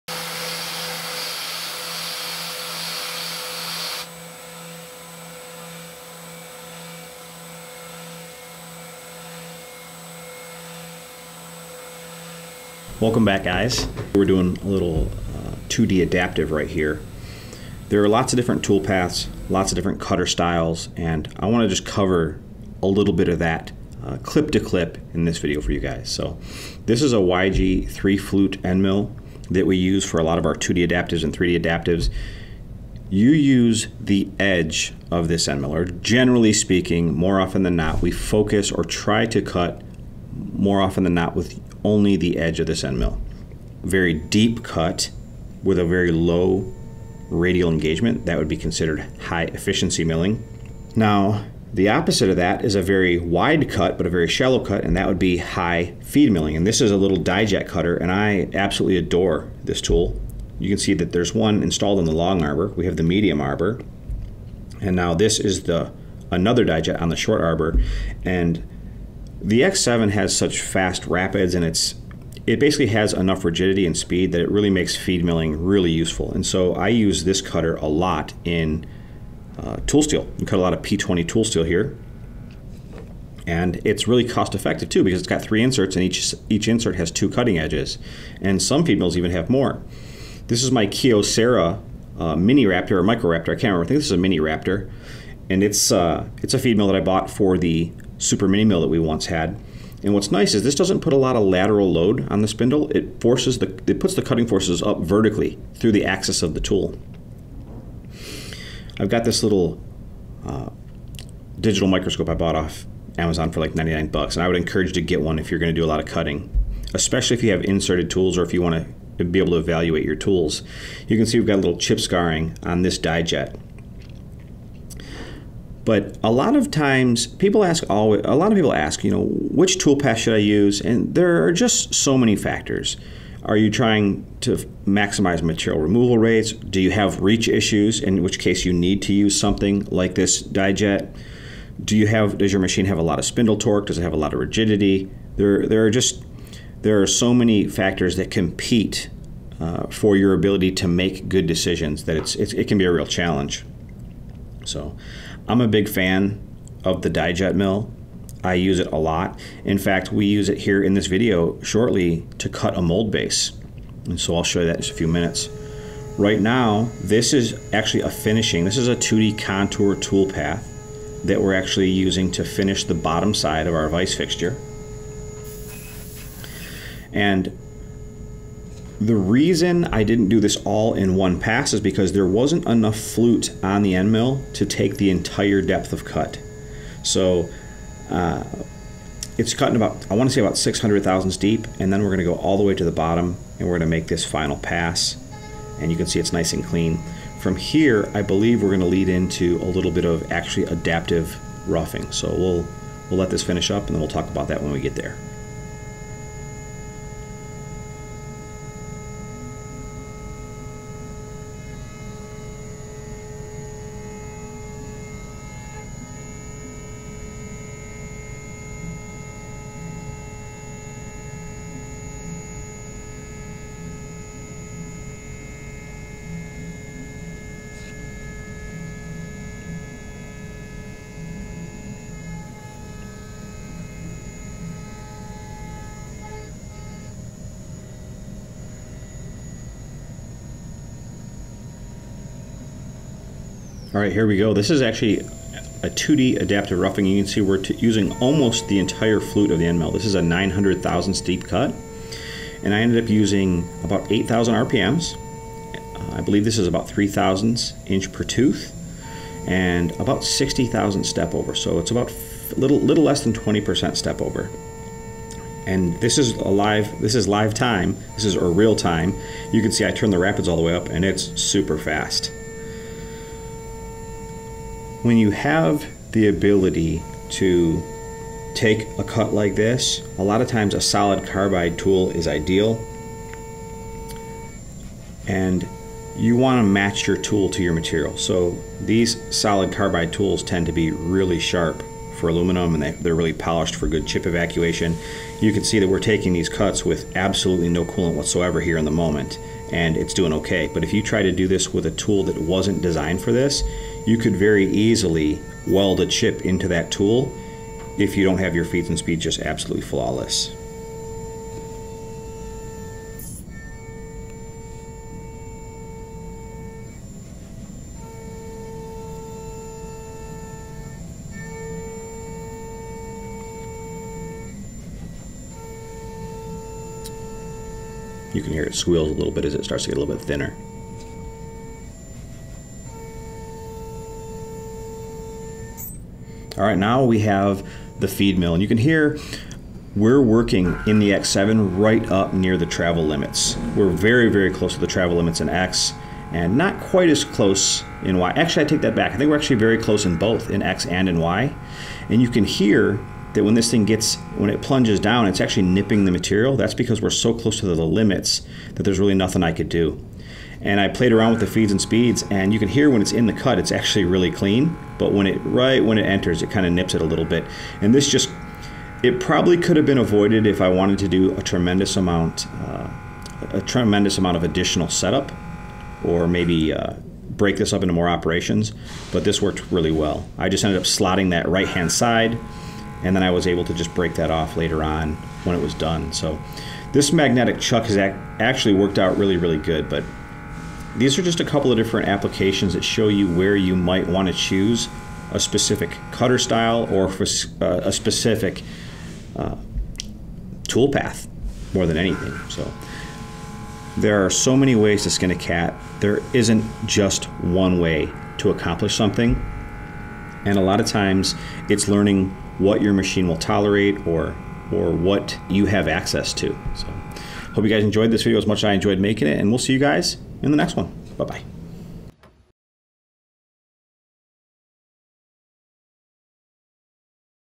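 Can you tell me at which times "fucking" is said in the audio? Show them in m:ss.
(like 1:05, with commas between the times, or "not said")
not said.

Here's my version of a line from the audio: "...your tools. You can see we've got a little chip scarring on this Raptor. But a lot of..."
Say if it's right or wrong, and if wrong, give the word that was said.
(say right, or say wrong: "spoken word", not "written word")
wrong: "Dijet", not "Raptor".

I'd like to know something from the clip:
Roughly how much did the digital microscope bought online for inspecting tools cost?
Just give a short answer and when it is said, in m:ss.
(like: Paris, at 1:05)
$99, at 1:53.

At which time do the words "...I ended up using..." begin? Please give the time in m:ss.
4:12.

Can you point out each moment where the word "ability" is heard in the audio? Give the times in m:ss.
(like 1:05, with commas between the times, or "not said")
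2:30, 4:36.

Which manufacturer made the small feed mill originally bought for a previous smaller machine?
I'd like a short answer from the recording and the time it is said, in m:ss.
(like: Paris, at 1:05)
Kyocera, at 1:30.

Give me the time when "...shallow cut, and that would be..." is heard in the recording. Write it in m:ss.
0:54.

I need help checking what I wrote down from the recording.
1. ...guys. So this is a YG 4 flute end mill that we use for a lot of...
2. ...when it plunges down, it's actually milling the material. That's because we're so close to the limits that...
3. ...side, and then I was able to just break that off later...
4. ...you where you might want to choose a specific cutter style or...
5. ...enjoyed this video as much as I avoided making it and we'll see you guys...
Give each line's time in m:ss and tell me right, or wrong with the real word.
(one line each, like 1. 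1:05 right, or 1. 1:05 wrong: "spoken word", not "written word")
1. 0:25 wrong: "3", not "4"
2. 5:54 wrong: "nipping", not "milling"
3. 6:21 right
4. 6:33 right
5. 6:57 wrong: "enjoyed", not "avoided".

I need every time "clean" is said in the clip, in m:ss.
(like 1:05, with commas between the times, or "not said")
3:16, 6:04.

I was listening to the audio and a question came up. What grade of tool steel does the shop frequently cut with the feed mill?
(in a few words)
P20.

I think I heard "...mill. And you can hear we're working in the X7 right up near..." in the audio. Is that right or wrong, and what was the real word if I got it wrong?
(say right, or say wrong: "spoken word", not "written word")
right.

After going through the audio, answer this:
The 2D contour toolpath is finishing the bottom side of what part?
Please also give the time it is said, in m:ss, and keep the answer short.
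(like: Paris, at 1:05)
vice fixture, at 2:53.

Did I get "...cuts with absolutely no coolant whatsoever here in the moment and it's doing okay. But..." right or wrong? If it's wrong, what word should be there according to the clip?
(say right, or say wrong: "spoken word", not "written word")
right.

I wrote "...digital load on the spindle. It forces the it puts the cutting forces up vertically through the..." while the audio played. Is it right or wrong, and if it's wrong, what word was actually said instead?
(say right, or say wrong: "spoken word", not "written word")
wrong: "lateral", not "digital".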